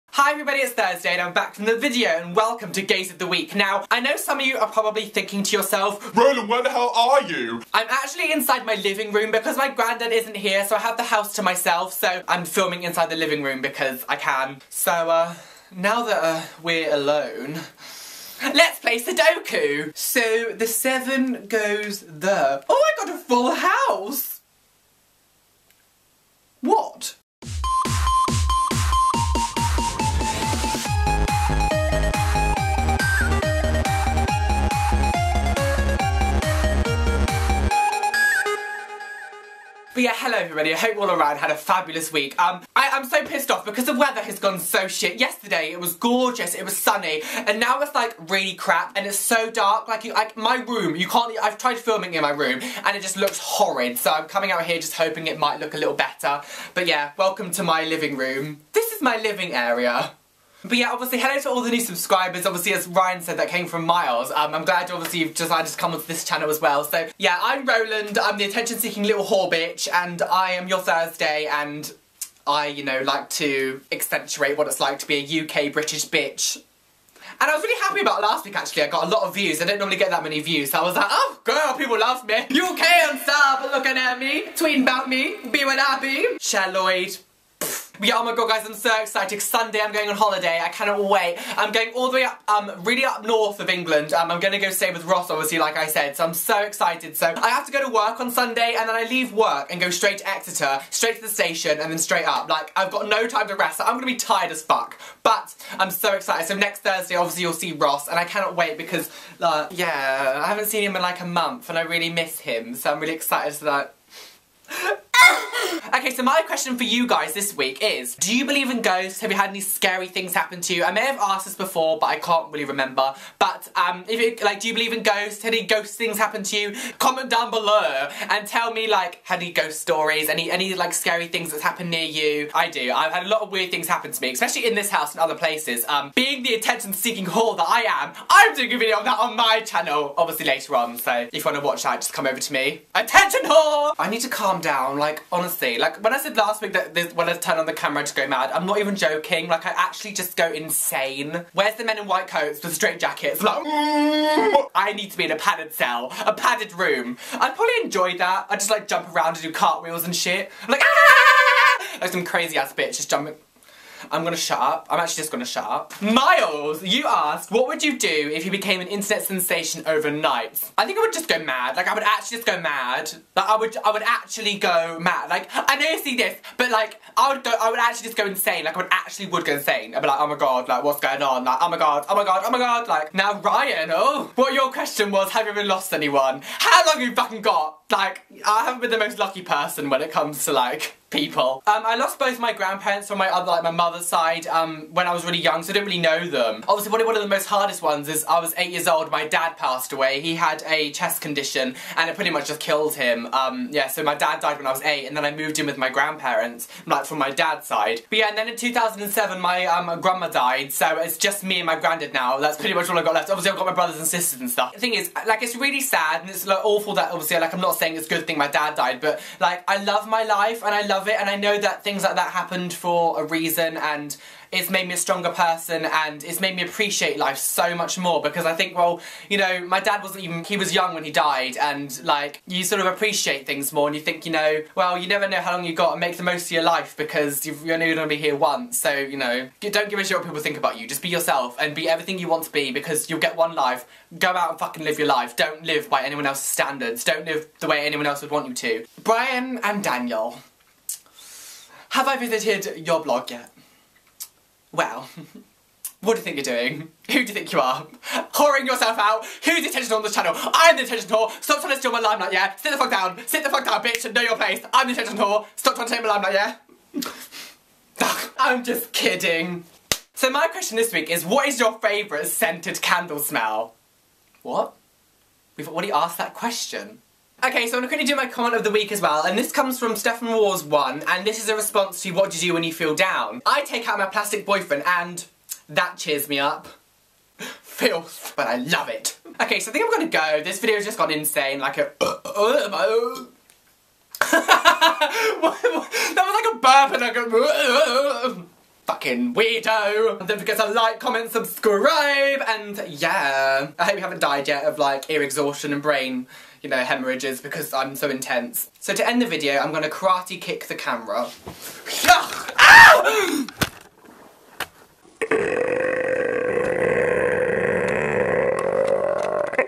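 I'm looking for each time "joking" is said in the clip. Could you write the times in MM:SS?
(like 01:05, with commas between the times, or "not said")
02:28.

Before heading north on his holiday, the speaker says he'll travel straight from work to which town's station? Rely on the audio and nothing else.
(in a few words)
Exeter.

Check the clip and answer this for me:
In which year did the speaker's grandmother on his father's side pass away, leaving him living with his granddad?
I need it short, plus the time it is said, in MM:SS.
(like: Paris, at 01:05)
2007, at 03:28.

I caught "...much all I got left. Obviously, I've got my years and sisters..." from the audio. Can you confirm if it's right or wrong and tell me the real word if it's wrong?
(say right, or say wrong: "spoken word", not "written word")
wrong: "brothers", not "years".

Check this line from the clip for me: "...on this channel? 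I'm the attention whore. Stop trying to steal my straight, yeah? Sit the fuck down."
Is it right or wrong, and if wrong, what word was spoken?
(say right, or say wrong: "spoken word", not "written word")
wrong: "limelight", not "straight".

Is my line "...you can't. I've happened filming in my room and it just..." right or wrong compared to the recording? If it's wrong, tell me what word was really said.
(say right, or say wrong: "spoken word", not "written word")
wrong: "tried", not "happened".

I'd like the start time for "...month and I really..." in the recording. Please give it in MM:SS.
01:51.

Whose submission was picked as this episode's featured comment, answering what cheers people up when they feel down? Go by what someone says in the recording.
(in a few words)
Stefan Wars one.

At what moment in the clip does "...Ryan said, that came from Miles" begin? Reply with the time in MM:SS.
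01:02.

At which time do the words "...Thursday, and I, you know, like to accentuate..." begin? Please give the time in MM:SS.
01:10.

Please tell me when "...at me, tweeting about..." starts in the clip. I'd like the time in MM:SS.
01:23.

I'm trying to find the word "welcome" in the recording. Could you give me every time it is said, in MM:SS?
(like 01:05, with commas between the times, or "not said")
00:02, 00:57.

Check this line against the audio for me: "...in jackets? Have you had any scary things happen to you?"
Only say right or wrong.
wrong.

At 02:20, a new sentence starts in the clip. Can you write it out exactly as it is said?
So if you want to watch that, just come over to me.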